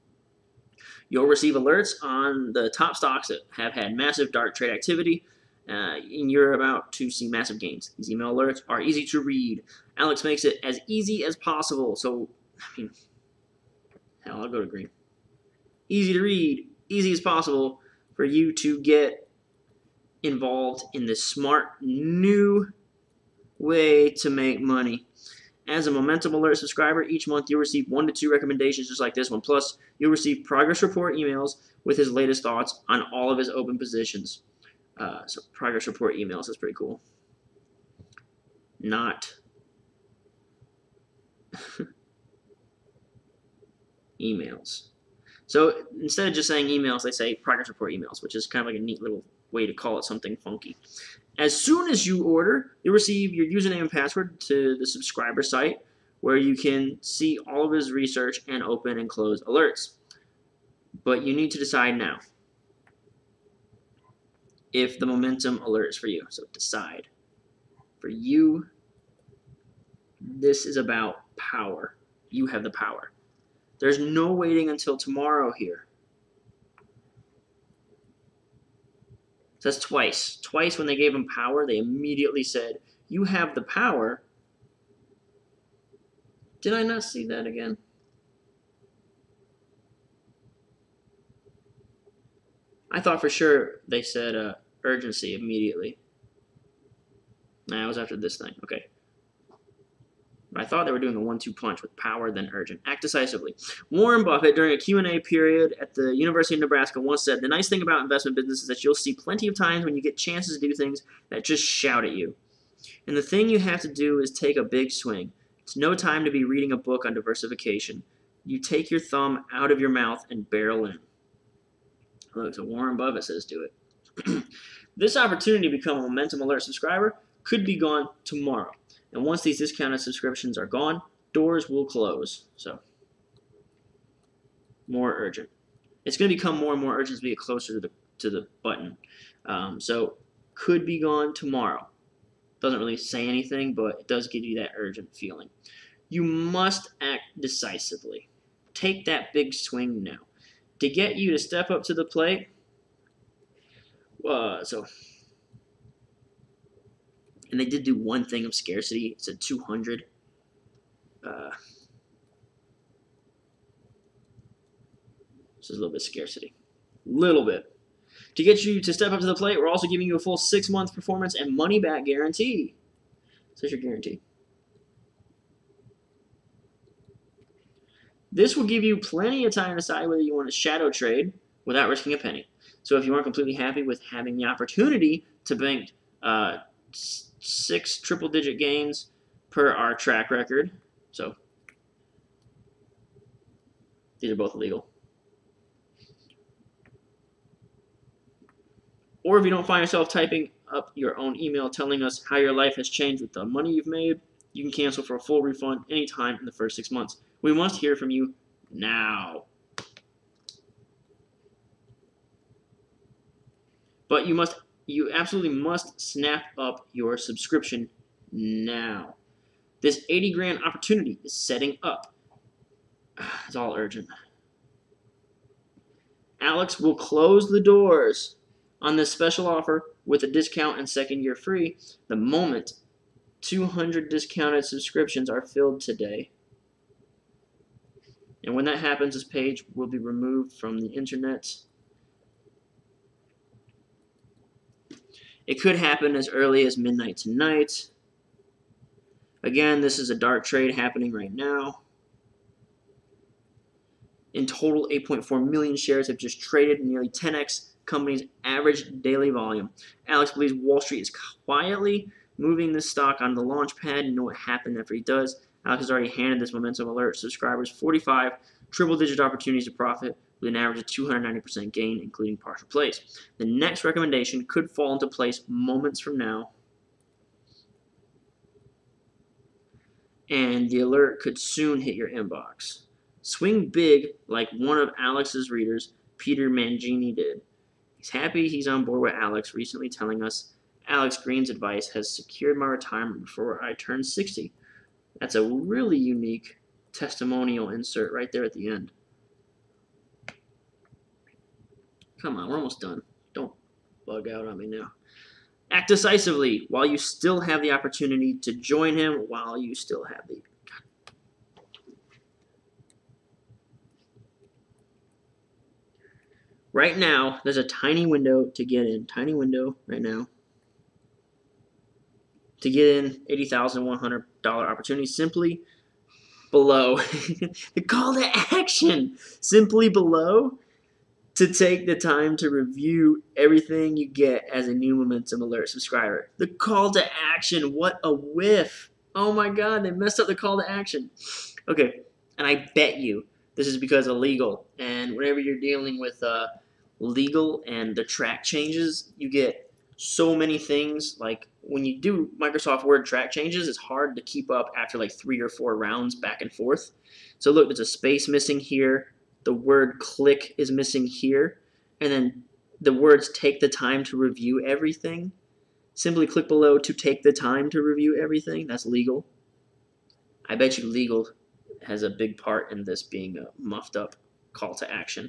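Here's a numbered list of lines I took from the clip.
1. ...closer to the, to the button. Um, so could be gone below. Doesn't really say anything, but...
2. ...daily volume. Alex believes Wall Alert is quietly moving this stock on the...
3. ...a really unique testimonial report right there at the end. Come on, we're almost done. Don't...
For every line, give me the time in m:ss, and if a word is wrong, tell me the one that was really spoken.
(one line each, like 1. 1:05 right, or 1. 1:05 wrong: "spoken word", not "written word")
1. 2:17 wrong: "tomorrow", not "below"
2. 4:19 wrong: "Street", not "Alert"
3. 4:55 wrong: "insert", not "report".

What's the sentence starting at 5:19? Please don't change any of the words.
Tiny window right now to get in $80,100 opportunity simply below.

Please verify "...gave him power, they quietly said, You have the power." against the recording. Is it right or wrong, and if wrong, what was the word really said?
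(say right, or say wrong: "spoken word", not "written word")
wrong: "immediately", not "quietly".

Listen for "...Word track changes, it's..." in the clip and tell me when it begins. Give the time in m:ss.
5:52.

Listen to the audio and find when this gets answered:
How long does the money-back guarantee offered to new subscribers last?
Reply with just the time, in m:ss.
2:50.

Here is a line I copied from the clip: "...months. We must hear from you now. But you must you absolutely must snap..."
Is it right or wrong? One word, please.
right.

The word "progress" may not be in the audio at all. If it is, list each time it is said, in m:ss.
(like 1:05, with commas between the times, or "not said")
0:30, 0:35, 0:47.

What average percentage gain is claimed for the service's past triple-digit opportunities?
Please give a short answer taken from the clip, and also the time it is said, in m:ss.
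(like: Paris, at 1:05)
290%, at 4:30.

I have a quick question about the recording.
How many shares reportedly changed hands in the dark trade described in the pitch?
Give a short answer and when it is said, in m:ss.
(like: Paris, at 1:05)
8.4 million, at 4:14.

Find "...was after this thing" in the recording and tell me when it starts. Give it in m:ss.
1:37.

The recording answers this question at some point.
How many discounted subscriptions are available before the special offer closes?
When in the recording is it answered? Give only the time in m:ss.
3:53.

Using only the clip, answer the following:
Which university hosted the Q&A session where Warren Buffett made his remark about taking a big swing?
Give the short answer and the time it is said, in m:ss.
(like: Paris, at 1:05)
University of Nebraska, at 1:46.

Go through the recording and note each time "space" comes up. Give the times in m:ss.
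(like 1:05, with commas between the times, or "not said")
5:57.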